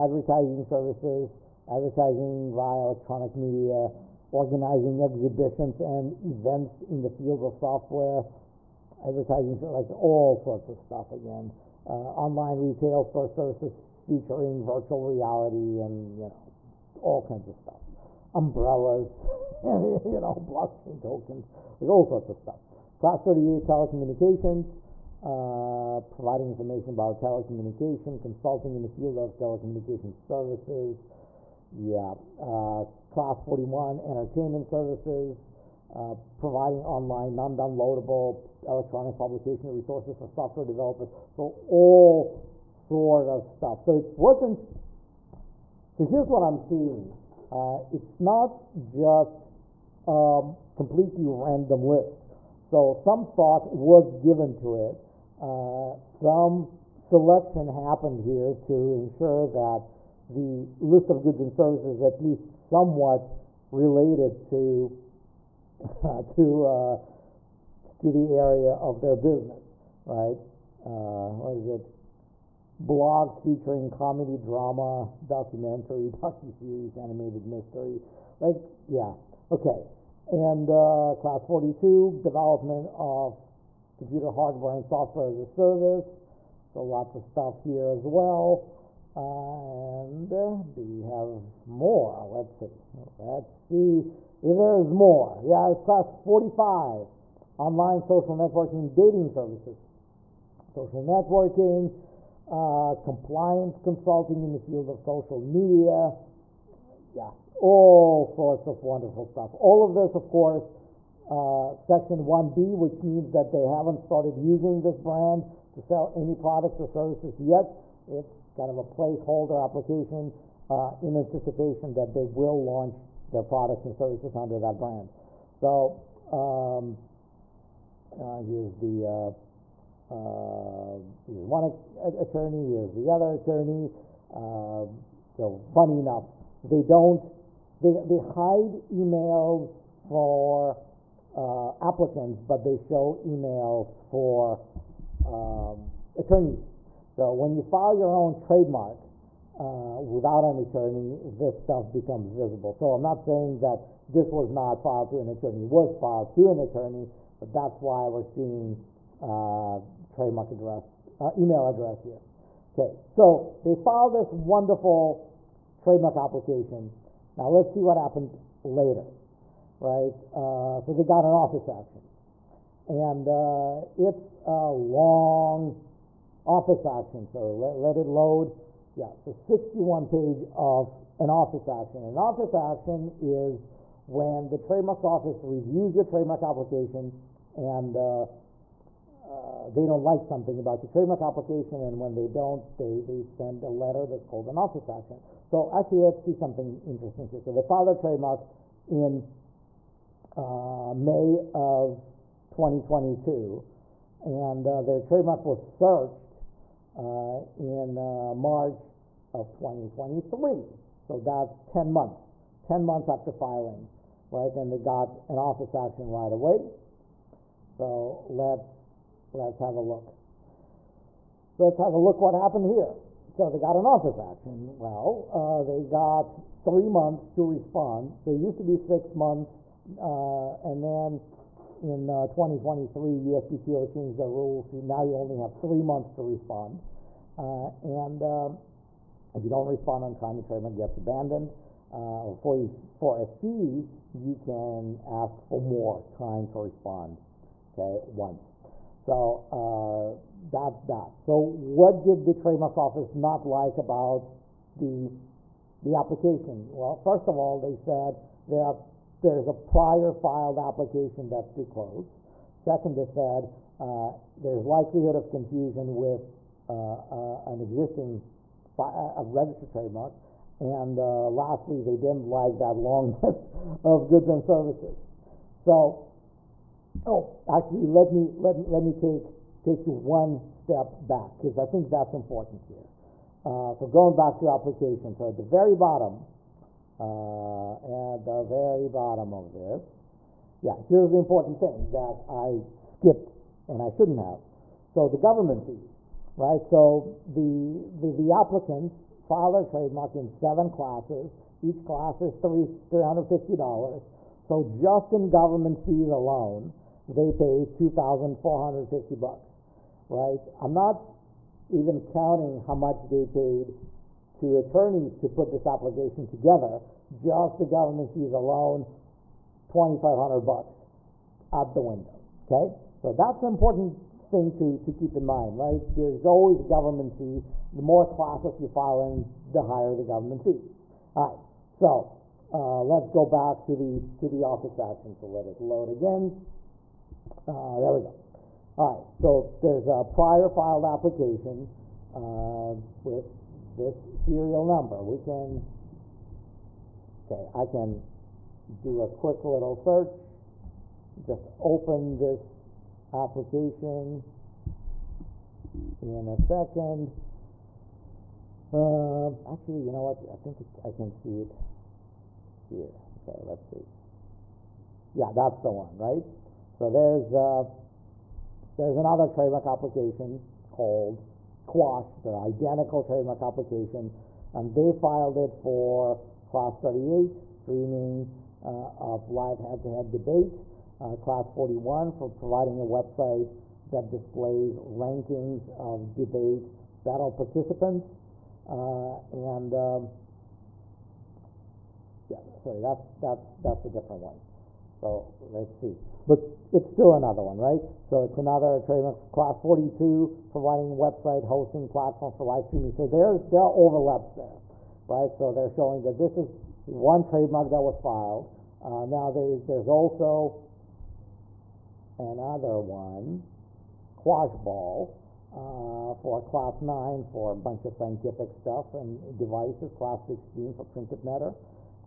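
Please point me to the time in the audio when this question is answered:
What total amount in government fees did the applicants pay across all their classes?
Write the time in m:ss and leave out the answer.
5:07.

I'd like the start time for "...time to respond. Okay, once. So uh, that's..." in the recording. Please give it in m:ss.
4:06.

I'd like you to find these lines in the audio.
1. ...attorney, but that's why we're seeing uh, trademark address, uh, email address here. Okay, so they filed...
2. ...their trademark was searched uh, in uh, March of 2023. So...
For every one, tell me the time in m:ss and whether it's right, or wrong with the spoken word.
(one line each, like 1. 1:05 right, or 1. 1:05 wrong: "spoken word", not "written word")
1. 2:36 right
2. 3:24 right.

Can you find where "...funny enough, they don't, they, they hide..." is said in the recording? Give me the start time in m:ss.
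2:15.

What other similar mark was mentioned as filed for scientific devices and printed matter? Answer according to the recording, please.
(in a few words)
Quashball.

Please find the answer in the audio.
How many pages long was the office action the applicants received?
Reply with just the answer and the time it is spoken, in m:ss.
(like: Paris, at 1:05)
61, at 2:59.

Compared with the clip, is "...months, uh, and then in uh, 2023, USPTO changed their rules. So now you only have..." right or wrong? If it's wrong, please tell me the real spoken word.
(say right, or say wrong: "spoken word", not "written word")
right.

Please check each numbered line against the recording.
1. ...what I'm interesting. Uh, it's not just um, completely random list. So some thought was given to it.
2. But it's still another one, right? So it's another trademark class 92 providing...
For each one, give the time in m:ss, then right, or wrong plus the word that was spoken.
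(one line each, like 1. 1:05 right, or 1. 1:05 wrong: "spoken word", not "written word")
1. 0:46 wrong: "seeing", not "interesting"
2. 6:36 wrong: "42", not "92".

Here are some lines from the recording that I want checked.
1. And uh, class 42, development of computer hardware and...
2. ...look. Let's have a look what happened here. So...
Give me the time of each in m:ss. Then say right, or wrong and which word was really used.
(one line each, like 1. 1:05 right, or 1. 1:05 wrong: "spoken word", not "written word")
1. 1:20 right
2. 3:39 right.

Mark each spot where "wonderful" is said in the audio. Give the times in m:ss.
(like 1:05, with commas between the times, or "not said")
1:48, 2:44.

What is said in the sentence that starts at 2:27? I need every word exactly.
So when you file your own trademark, uh, without an attorney, this stuff becomes visible.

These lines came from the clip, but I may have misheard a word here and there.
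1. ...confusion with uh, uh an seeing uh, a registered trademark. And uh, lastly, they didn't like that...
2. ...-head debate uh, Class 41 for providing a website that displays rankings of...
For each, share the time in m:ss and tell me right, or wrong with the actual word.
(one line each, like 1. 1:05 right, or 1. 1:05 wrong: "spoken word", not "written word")
1. 4:25 wrong: "existing", not "seeing"
2. 6:20 right.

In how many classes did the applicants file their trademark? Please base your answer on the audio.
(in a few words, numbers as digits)
7.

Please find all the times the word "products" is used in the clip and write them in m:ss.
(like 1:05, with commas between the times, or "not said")
1:56, 2:03.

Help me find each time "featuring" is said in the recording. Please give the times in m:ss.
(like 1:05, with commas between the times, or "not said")
0:13, 1:13.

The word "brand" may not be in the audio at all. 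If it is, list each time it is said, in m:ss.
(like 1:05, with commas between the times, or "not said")
1:54, 2:04.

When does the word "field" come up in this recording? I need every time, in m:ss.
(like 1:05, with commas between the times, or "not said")
0:07, 0:28, 1:44.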